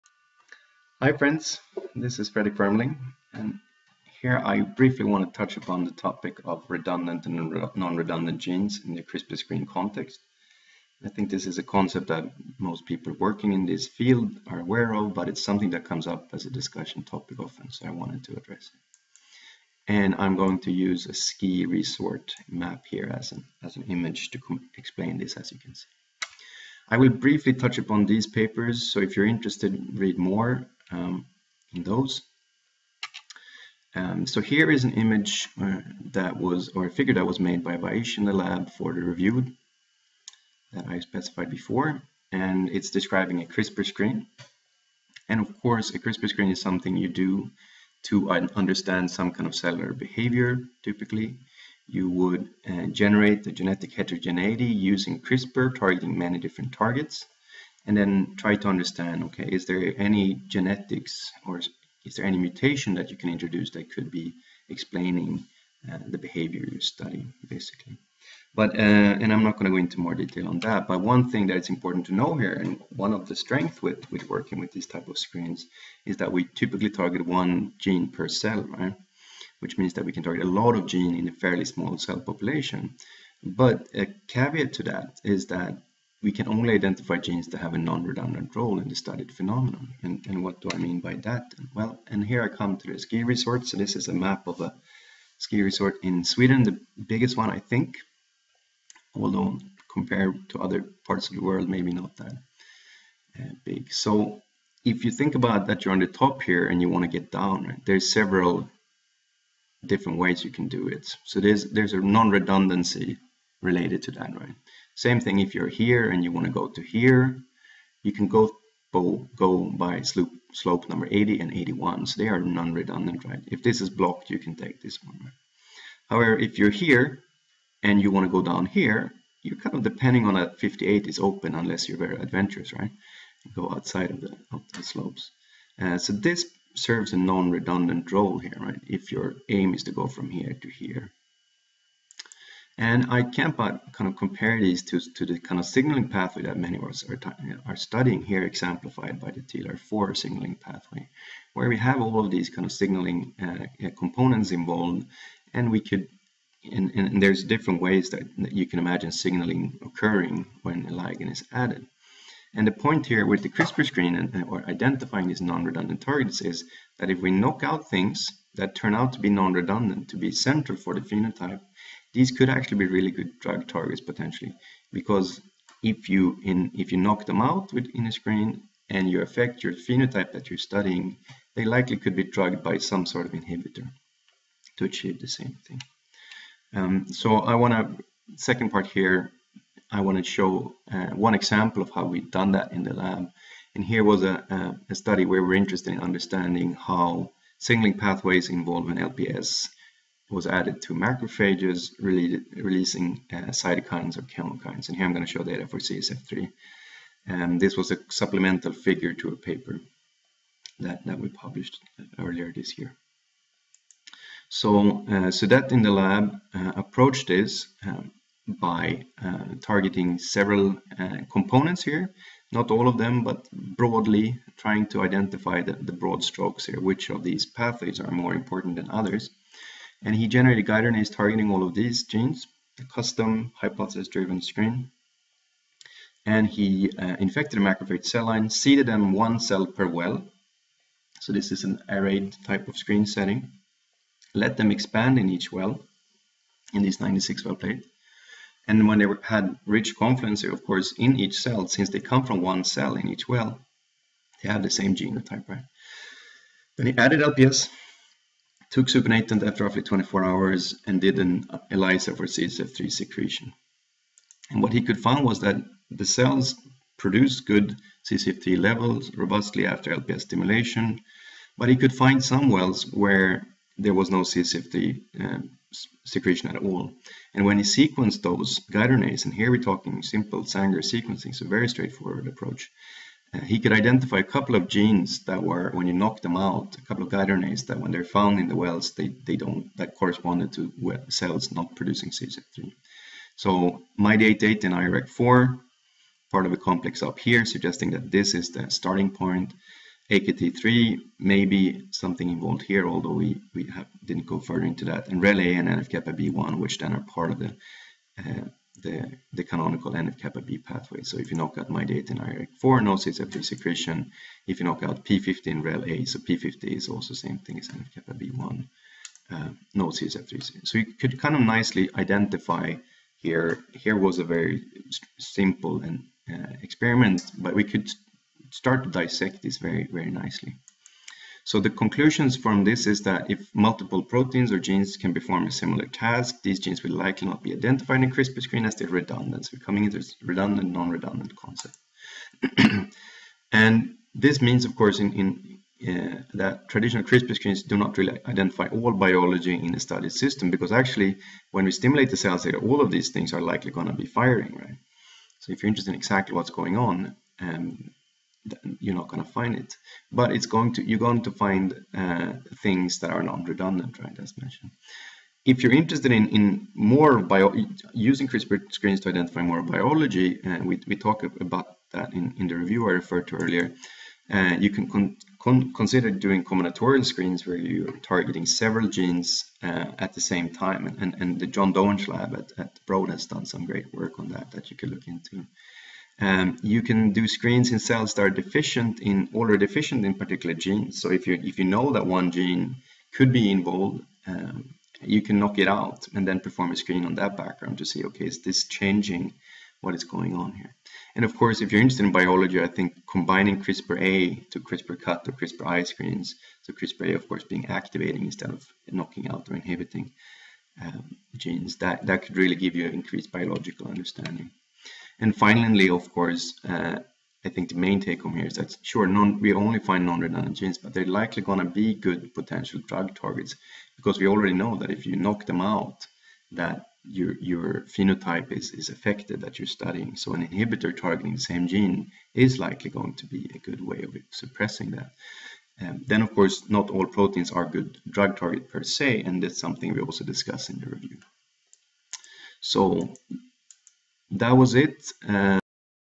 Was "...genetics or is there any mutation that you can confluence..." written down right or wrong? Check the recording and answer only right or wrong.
wrong.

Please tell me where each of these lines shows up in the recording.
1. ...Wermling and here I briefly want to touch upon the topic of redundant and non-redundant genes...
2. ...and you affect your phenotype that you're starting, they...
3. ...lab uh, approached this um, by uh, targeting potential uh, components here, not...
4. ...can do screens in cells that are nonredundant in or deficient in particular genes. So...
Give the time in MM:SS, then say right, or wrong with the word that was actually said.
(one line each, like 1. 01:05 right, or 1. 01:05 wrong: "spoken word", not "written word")
1. 00:02 right
2. 02:58 wrong: "studying", not "starting"
3. 03:35 wrong: "several", not "potential"
4. 06:26 wrong: "deficient", not "nonredundant".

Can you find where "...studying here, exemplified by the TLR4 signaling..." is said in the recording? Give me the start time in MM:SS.
02:27.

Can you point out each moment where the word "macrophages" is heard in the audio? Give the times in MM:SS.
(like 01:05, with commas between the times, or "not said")
03:20, 03:57.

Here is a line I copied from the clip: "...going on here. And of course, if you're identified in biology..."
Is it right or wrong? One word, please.
wrong.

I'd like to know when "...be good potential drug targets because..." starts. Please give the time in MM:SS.
07:01.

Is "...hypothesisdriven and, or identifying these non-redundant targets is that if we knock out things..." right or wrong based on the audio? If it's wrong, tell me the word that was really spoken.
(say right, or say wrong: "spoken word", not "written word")
wrong: "screen", not "hypothesisdriven".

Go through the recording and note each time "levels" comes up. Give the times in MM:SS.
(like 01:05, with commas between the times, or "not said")
04:28.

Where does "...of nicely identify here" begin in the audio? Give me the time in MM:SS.
05:21.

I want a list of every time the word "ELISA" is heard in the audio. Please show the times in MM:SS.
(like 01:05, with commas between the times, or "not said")
04:21.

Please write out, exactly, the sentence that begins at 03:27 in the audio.
And um, this was a supplemental figure to a paper that, that we published uh, earlier this year.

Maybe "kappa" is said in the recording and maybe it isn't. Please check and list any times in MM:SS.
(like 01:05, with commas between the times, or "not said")
05:05, 05:09, 05:17.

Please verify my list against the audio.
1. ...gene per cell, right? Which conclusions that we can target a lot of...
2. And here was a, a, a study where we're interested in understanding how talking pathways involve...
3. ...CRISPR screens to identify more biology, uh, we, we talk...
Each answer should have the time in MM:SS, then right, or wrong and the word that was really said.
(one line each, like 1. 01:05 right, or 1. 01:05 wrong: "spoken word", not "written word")
1. 01:17 wrong: "means", not "conclusions"
2. 03:13 wrong: "signaling", not "talking"
3. 06:08 right.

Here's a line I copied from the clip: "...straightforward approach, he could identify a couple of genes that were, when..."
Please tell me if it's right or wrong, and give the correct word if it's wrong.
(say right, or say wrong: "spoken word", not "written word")
right.